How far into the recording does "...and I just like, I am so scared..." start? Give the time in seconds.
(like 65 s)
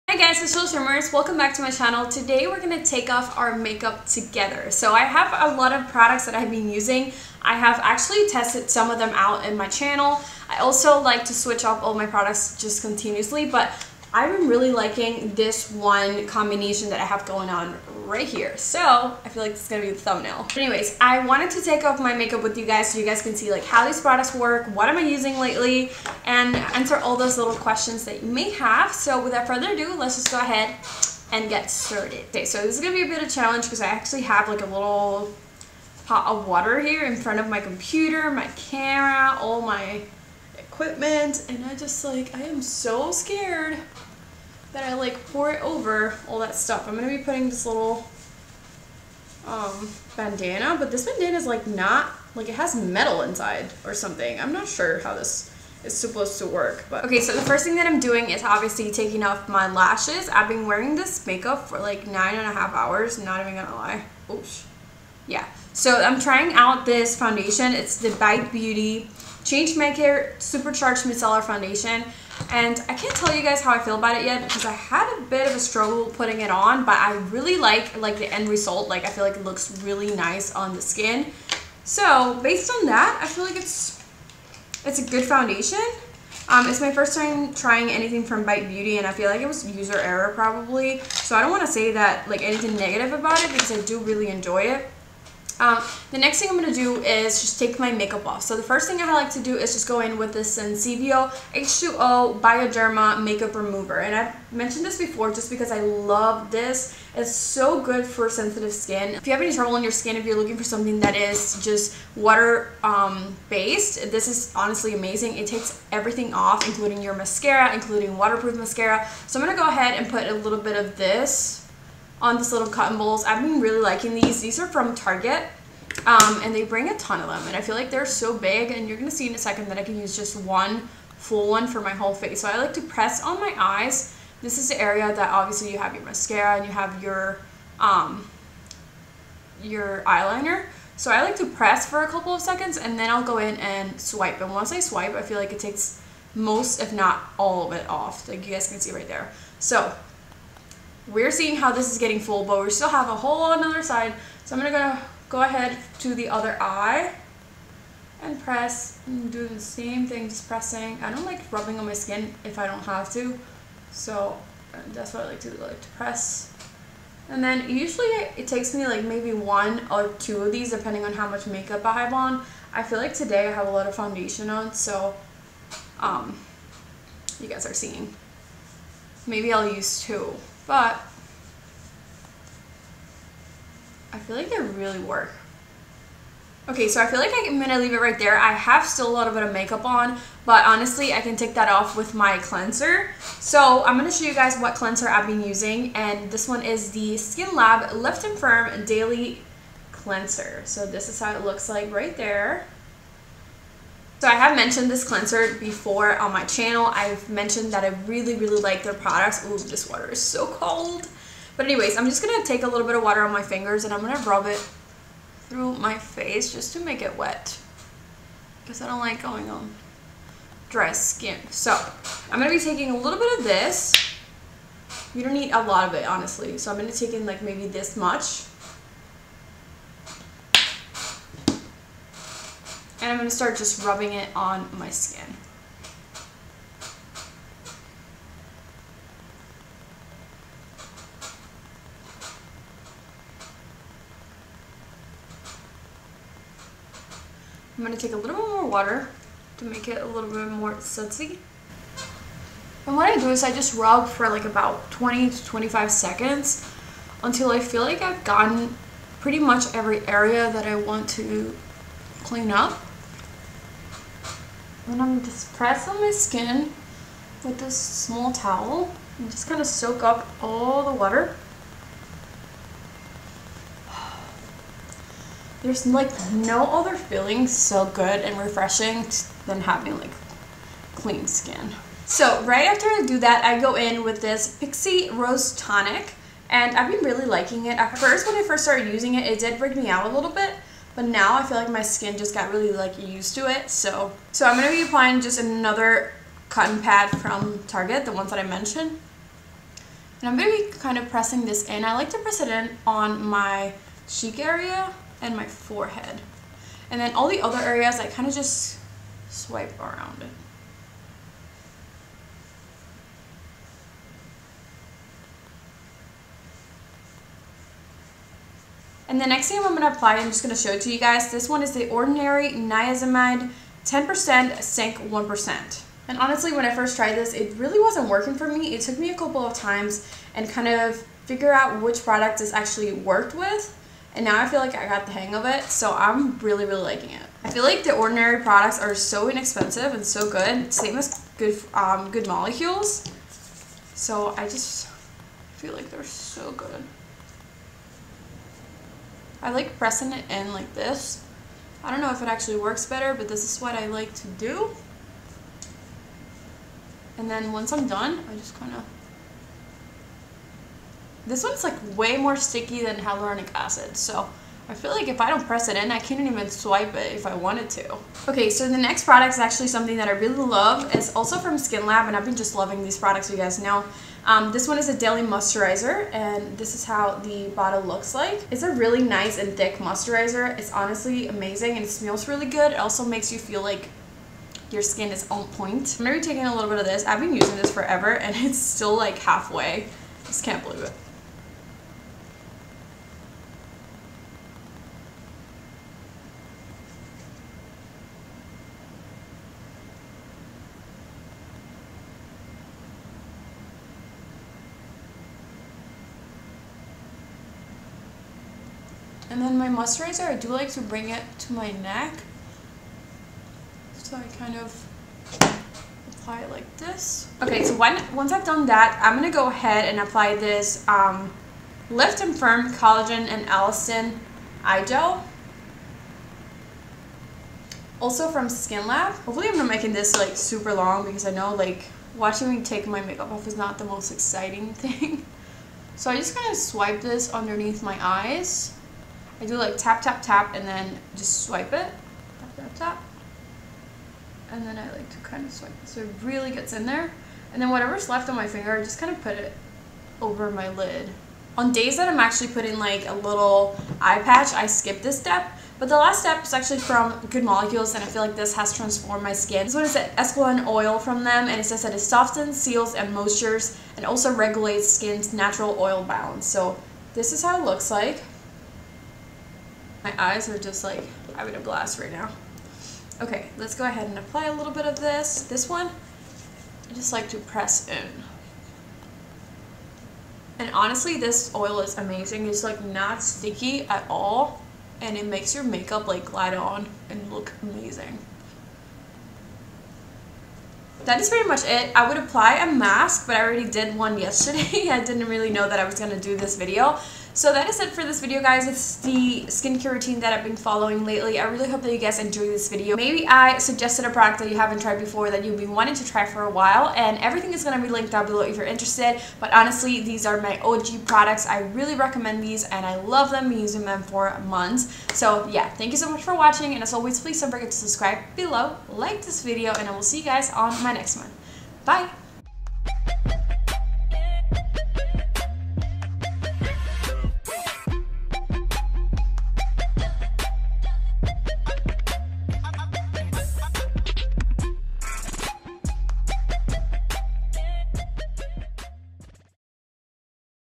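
41 s.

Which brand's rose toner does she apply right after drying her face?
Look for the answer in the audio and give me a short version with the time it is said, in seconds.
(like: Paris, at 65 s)
Pixi, at 284 s.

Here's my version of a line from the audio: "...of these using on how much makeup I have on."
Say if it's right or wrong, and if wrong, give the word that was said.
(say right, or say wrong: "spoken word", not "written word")
wrong: "depending", not "using".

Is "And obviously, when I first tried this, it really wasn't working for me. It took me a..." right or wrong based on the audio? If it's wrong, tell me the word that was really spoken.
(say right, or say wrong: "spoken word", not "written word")
wrong: "honestly", not "obviously".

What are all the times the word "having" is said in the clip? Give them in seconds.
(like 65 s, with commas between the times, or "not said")
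279 s, 471 s.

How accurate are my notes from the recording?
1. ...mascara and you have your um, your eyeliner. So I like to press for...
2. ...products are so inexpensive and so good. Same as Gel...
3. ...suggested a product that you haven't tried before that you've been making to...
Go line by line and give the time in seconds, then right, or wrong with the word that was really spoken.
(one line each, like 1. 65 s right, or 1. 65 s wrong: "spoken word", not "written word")
1. 136 s right
2. 338 s wrong: "Good", not "Gel"
3. 503 s wrong: "wanting", not "making".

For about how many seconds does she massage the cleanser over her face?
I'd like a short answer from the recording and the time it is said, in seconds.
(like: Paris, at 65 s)
20 to 25, at 254 s.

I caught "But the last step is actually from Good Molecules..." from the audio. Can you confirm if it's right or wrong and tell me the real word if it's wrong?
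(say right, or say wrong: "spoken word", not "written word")
right.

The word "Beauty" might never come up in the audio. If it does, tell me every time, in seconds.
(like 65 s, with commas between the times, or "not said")
68 s, 88 s.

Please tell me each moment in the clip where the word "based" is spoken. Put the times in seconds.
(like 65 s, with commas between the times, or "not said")
82 s, 113 s.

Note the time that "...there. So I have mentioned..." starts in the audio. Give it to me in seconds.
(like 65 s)
202 s.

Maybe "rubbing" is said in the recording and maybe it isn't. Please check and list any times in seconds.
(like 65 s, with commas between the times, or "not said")
161 s, 233 s.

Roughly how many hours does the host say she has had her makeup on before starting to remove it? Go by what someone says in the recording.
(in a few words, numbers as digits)
9.5.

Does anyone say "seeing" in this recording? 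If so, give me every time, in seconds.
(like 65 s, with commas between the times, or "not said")
151 s, 177 s.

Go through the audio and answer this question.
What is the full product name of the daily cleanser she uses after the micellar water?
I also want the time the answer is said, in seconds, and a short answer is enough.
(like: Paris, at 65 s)
Lift and Firm Daily Cleanser, at 197 s.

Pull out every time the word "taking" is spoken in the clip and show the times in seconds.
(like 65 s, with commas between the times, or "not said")
58 s, 222 s, 386 s.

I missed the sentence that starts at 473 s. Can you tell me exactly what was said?
Okay, let's go ahead and apply a little bit of this.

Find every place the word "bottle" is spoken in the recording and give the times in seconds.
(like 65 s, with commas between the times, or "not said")
377 s.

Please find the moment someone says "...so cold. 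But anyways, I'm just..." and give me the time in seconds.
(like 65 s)
210 s.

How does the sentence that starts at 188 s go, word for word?
I have still a little bit of makeup on, but honestly, I can take that off with my cleanser.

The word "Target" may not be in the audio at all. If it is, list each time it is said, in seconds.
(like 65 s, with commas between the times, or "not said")
124 s, 297 s.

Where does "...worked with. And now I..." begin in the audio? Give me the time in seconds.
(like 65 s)
332 s.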